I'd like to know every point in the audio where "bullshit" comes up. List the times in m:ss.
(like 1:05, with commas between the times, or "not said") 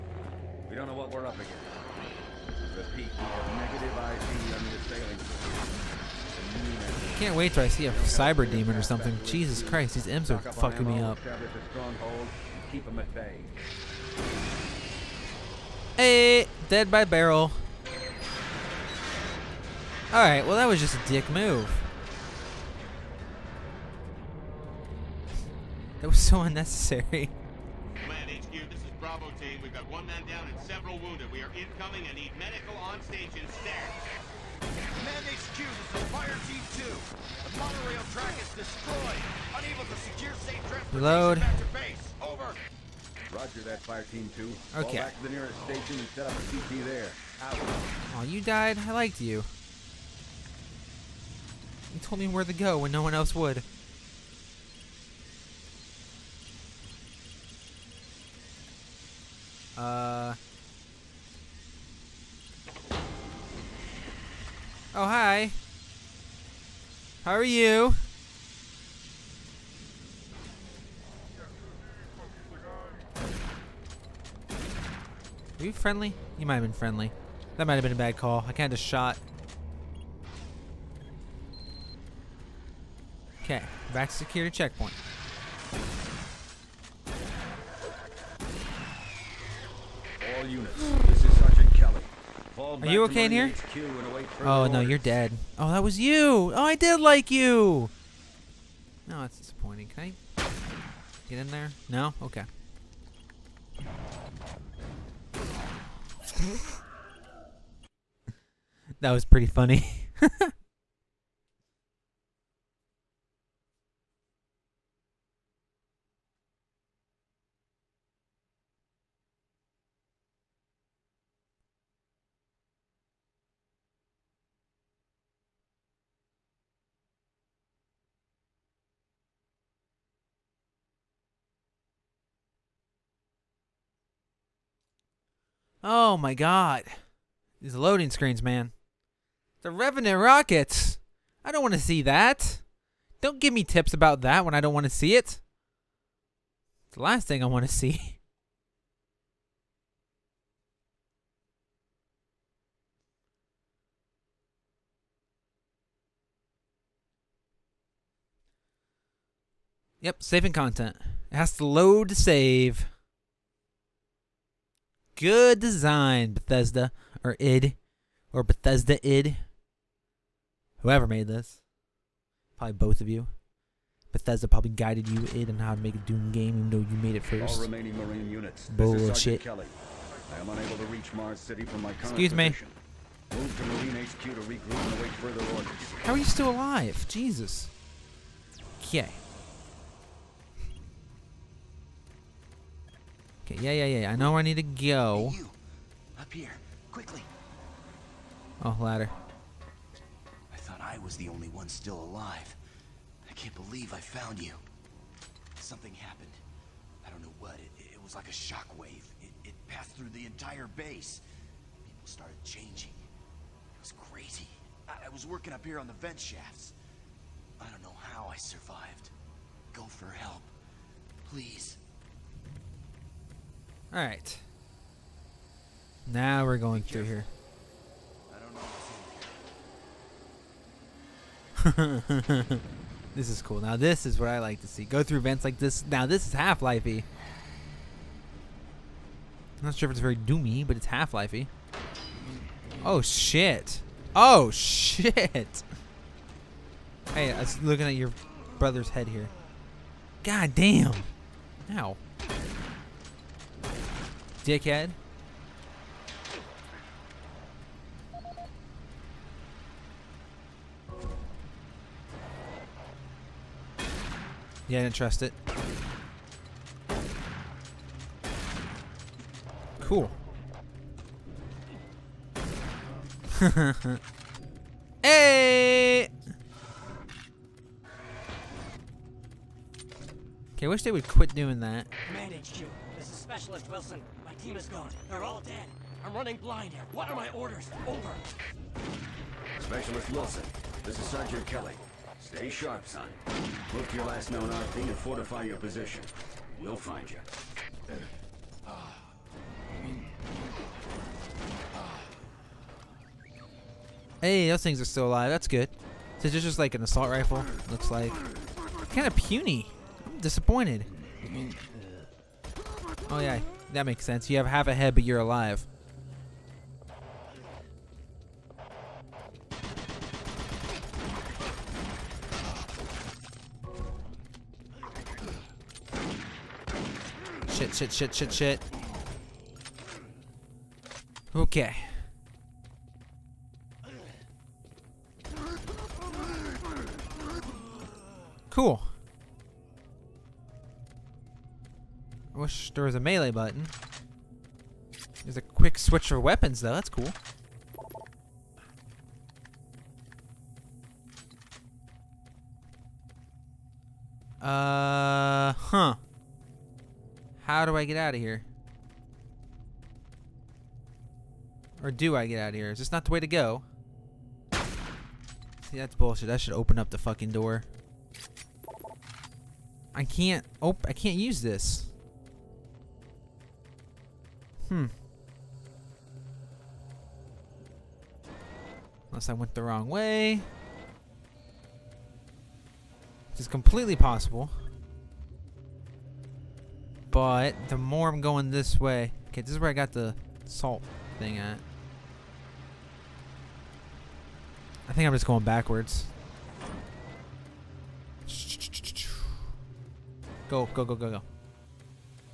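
2:58, 6:05.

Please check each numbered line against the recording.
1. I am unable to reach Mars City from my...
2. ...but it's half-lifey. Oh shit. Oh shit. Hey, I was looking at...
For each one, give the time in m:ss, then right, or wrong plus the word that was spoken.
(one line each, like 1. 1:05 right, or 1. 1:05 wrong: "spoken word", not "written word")
1. 2:59 right
2. 4:00 right.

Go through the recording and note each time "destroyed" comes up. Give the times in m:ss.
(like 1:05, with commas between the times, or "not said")
0:38.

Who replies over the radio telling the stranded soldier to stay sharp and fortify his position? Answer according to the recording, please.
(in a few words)
Sergeant Kelly.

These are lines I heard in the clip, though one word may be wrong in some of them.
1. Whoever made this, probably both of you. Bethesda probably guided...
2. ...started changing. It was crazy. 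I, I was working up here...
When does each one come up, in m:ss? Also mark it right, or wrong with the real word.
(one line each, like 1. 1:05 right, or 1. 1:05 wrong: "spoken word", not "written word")
1. 2:50 right
2. 3:32 right.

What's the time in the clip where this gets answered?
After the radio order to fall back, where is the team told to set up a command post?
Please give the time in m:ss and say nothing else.
0:45.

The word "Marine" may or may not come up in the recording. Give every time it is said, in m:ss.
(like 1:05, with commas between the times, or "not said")
2:57, 3:03.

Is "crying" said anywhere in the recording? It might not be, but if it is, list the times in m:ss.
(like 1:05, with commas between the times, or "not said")
not said.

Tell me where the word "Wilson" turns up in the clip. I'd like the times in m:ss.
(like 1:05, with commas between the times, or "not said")
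4:43, 4:50.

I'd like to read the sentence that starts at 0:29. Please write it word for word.
Got one man down and several wounded.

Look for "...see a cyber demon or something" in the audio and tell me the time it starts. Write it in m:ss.
0:07.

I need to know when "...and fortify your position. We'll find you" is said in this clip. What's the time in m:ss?
4:54.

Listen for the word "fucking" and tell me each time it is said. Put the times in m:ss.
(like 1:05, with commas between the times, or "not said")
0:10, 6:06.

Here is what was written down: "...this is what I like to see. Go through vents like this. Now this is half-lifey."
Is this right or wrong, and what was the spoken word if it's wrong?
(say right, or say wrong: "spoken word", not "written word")
right.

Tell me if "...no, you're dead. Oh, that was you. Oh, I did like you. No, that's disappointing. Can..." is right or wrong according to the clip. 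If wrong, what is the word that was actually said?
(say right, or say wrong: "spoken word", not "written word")
right.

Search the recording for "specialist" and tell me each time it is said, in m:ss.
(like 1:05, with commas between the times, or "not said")
4:43, 4:49.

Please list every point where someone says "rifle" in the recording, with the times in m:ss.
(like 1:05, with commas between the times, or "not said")
5:07.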